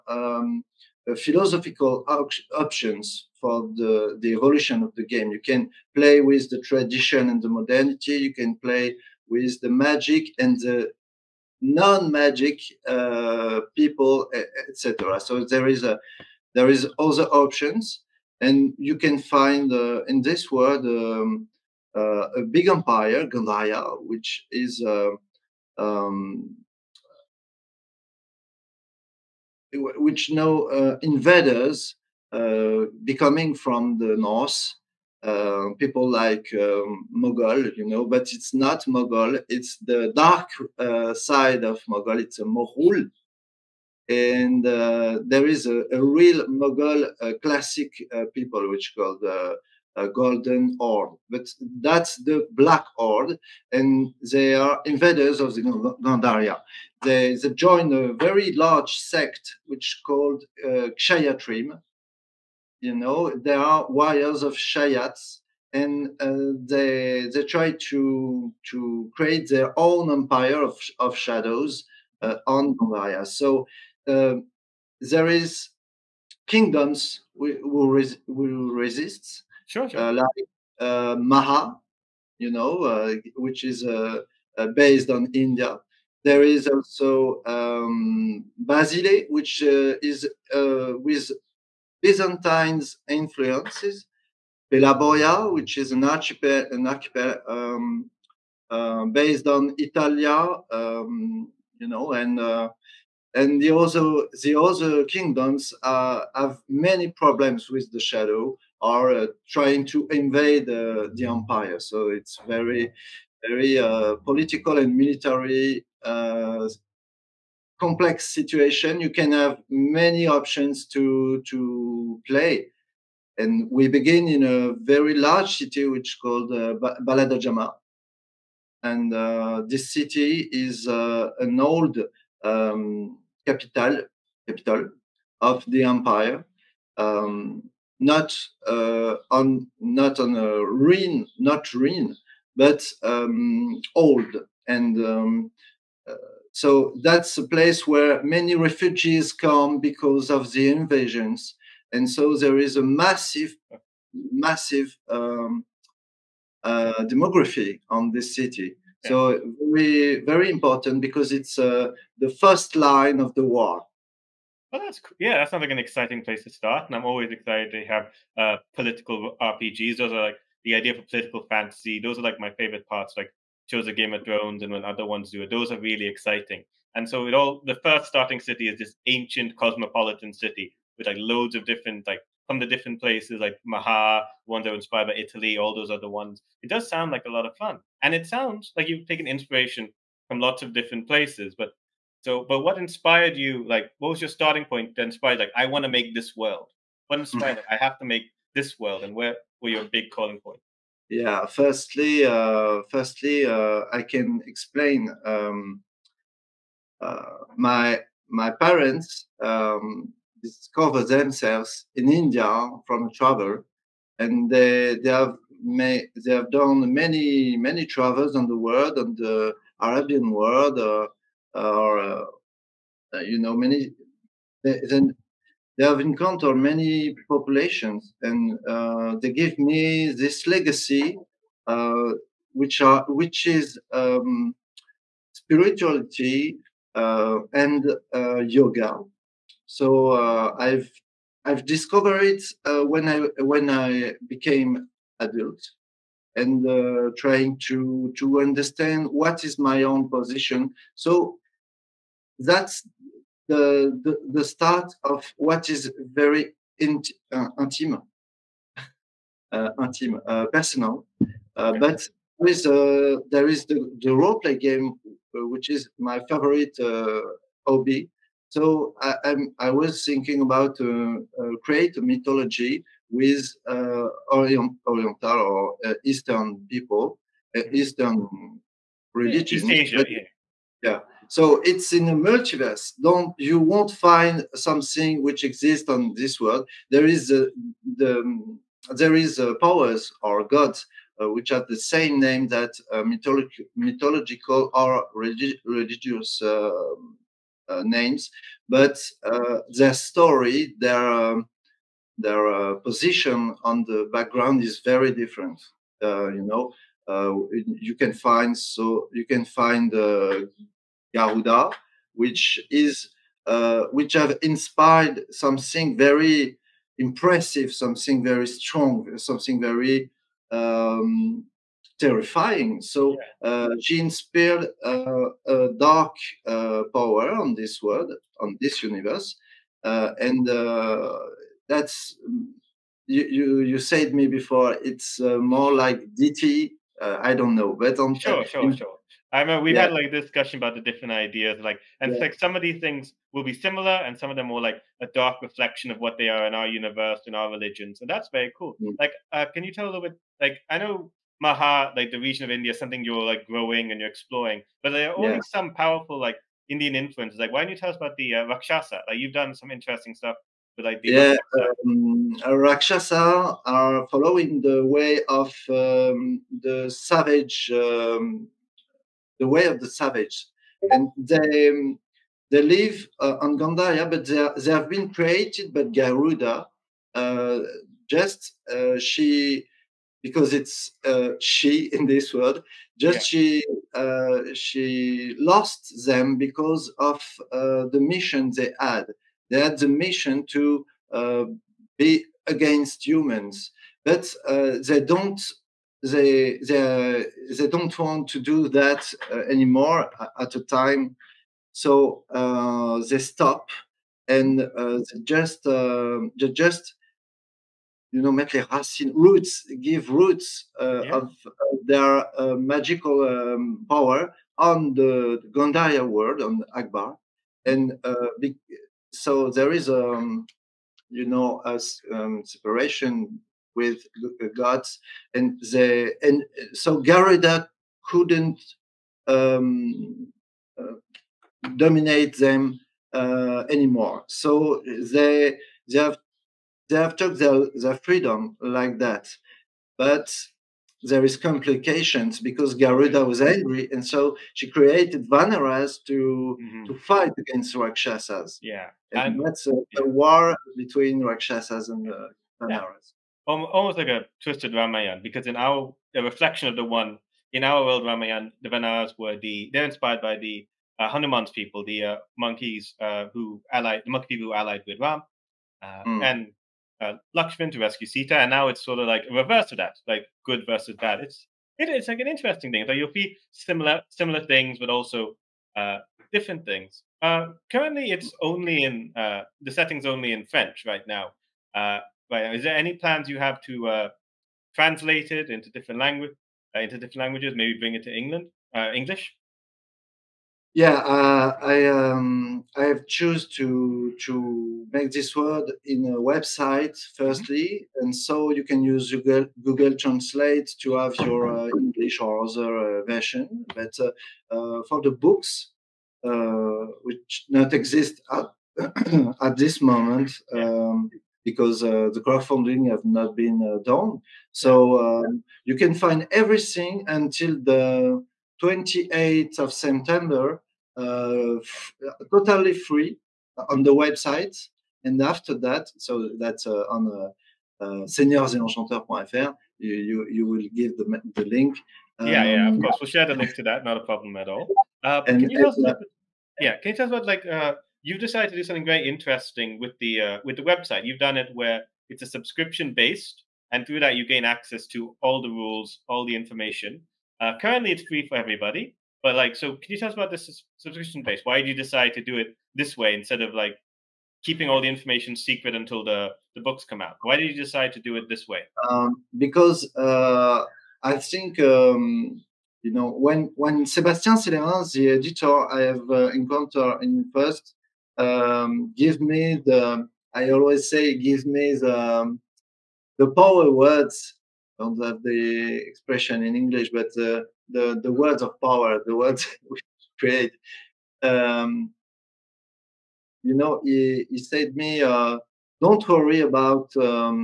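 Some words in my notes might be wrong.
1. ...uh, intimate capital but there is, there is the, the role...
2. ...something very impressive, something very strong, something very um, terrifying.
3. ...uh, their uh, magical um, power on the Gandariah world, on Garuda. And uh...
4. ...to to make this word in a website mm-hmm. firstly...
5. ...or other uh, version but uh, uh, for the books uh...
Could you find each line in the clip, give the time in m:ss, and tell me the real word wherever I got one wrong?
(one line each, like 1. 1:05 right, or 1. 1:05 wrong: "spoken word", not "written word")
1. 4:19 wrong: "personal", not "capital"
2. 5:15 right
3. 6:51 wrong: "Akbar", not "Garuda"
4. 8:13 right
5. 8:22 right.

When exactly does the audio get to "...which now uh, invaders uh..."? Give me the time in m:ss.
0:29.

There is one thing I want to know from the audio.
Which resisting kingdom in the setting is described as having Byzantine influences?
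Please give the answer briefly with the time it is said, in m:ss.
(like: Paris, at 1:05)
Basile, at 1:28.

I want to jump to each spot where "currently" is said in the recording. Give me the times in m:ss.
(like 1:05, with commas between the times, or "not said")
7:57, 9:07.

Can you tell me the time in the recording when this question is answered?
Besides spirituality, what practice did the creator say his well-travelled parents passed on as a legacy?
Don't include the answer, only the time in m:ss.
3:58.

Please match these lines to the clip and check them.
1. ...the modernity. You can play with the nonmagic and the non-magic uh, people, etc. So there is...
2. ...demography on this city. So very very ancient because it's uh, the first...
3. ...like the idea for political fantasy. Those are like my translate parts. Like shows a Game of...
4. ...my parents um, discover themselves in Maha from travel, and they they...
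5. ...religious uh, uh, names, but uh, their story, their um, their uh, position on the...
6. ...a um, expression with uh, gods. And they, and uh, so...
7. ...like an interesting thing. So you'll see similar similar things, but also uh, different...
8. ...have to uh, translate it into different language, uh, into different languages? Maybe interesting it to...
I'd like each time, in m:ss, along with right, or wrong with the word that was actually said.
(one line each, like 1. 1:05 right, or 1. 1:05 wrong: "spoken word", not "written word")
1. 0:07 wrong: "magic", not "nonmagic"
2. 2:37 wrong: "important", not "ancient"
3. 2:50 wrong: "favorite", not "translate"
4. 3:28 wrong: "India", not "Maha"
5. 4:55 right
6. 7:01 wrong: "separation", not "expression"
7. 7:52 right
8. 8:03 wrong: "bring", not "interesting".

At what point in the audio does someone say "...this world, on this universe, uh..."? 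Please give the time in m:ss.
5:27.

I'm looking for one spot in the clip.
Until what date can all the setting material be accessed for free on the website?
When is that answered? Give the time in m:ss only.
8:38.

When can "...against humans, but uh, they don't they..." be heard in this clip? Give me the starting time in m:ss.
6:32.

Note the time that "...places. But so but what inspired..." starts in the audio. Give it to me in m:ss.
3:11.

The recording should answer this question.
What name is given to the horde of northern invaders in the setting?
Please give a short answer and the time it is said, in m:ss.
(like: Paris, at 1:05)
black horde, at 0:52.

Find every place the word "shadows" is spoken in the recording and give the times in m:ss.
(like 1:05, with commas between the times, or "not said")
1:11, 1:48.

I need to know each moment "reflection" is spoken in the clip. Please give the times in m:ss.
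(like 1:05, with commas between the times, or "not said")
5:45, 7:36.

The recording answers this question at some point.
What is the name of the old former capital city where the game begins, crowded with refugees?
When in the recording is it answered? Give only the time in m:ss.
2:07.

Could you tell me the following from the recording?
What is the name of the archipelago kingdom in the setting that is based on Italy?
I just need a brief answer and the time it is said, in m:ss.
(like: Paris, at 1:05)
Pelaboya, at 1:34.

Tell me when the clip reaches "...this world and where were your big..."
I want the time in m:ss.
3:18.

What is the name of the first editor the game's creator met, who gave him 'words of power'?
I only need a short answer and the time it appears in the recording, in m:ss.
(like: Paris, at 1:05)
Sébastien Célerin, at 9:23.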